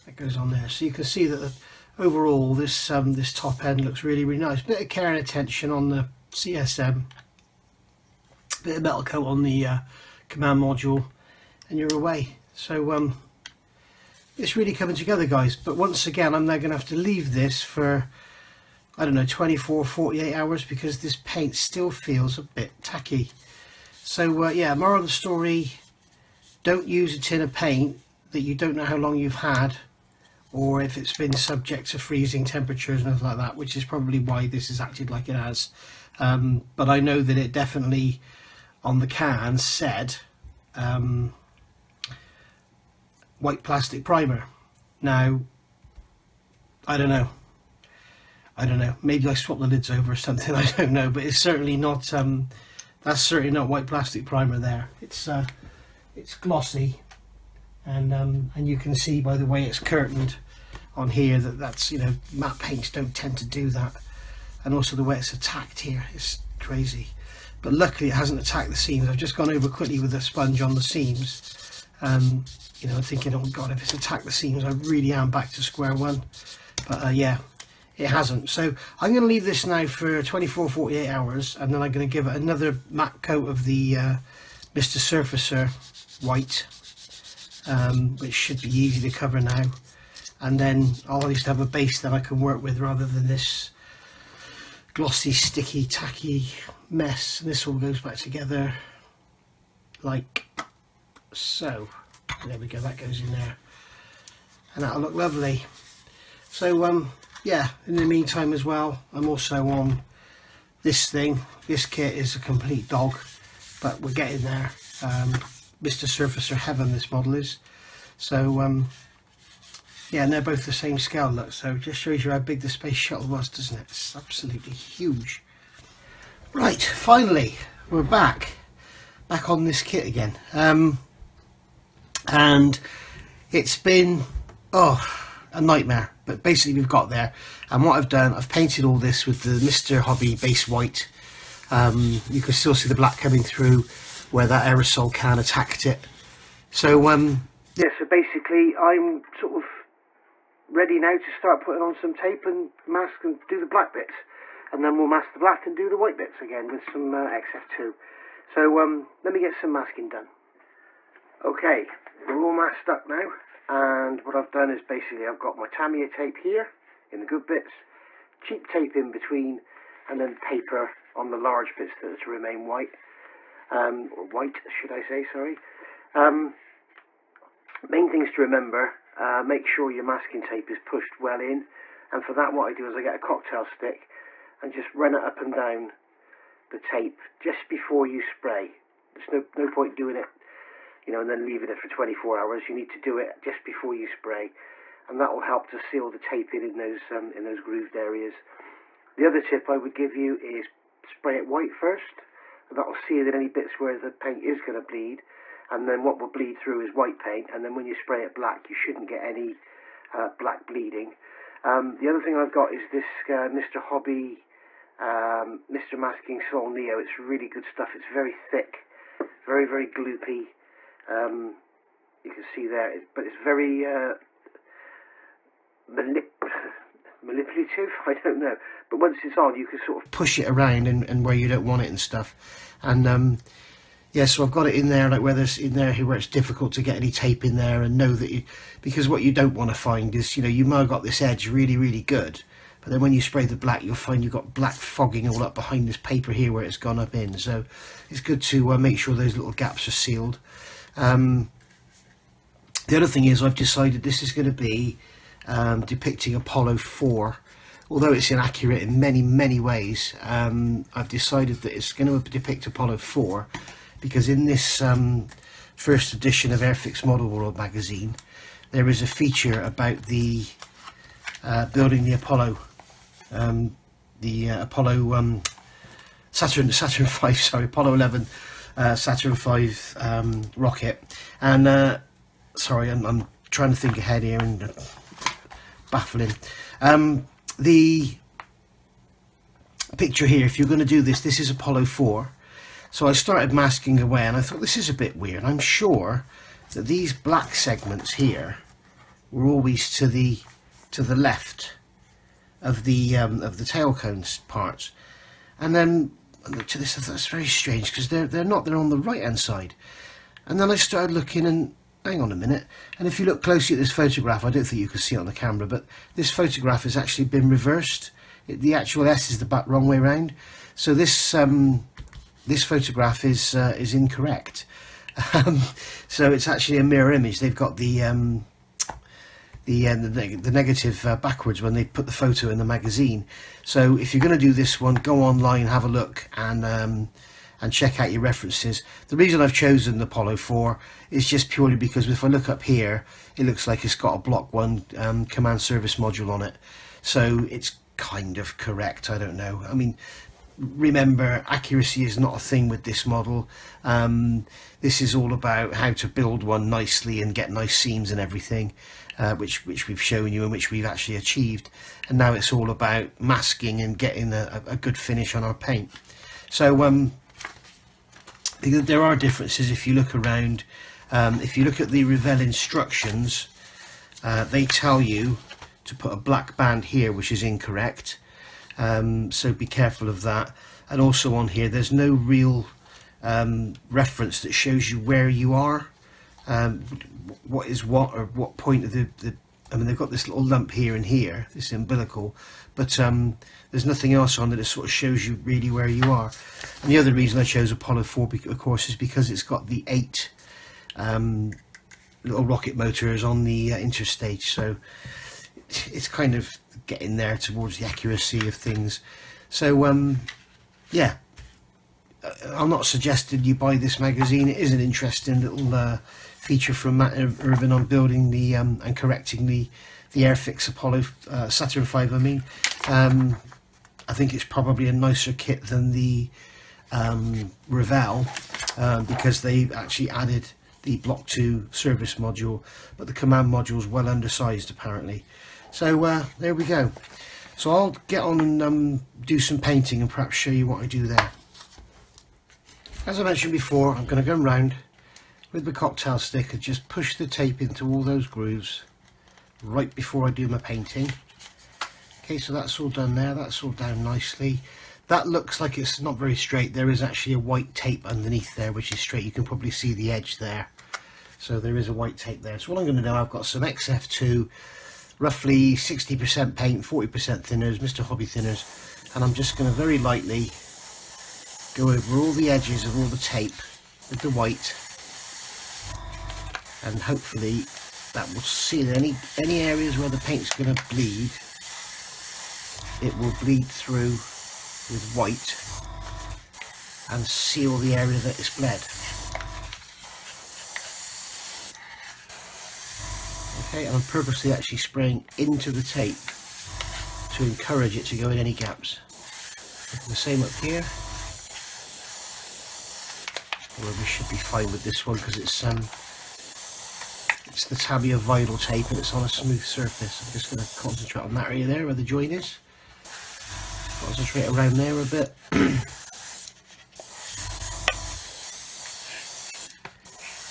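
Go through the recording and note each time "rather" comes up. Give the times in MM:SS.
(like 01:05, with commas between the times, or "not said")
01:32.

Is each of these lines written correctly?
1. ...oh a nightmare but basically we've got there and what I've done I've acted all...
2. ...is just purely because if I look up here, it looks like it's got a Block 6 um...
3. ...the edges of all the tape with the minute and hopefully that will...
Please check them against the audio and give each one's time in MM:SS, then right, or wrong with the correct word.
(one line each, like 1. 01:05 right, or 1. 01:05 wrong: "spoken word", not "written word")
1. 02:14 wrong: "painted", not "acted"
2. 05:41 wrong: "1", not "6"
3. 07:52 wrong: "white", not "minute".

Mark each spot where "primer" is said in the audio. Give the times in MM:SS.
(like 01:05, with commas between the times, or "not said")
00:44, 00:54.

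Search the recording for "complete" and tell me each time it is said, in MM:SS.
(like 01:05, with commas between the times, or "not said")
01:52.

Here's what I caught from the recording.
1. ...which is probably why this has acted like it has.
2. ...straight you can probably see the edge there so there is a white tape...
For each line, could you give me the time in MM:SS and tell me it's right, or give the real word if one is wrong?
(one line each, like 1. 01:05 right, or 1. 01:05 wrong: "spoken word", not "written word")
1. 00:33 right
2. 07:38 right.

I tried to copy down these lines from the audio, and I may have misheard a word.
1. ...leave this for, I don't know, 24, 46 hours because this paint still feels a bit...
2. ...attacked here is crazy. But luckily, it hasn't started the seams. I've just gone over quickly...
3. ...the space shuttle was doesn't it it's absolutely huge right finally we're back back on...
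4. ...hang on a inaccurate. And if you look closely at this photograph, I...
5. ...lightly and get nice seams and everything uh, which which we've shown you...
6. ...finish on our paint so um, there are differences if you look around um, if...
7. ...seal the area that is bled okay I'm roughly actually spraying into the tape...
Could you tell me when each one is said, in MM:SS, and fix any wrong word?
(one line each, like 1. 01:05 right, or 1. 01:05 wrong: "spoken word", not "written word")
1. 00:16 wrong: "48", not "46"
2. 01:05 wrong: "attacked", not "started"
3. 02:02 right
4. 05:12 wrong: "minute", not "inaccurate"
5. 05:56 wrong: "nicely", not "lightly"
6. 06:04 right
7. 08:07 wrong: "purposely", not "roughly".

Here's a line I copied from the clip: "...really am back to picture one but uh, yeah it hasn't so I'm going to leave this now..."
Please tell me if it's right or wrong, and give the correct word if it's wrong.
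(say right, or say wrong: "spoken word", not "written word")
wrong: "square", not "picture".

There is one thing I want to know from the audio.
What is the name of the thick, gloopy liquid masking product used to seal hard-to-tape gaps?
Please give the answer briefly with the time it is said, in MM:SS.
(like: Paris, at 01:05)
Mr. Masking Sol Neo, at 03:35.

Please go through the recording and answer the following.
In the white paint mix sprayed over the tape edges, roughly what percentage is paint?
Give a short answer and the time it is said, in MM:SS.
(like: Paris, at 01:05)
60%, at 07:45.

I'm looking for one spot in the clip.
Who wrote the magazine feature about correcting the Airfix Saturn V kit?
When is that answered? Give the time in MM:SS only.
06:56.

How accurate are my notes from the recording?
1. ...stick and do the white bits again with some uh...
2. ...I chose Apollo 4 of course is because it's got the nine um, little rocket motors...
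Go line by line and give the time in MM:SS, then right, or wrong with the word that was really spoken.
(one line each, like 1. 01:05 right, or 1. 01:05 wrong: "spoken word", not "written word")
1. 02:35 wrong: "black", not "stick"
2. 06:37 wrong: "eight", not "nine".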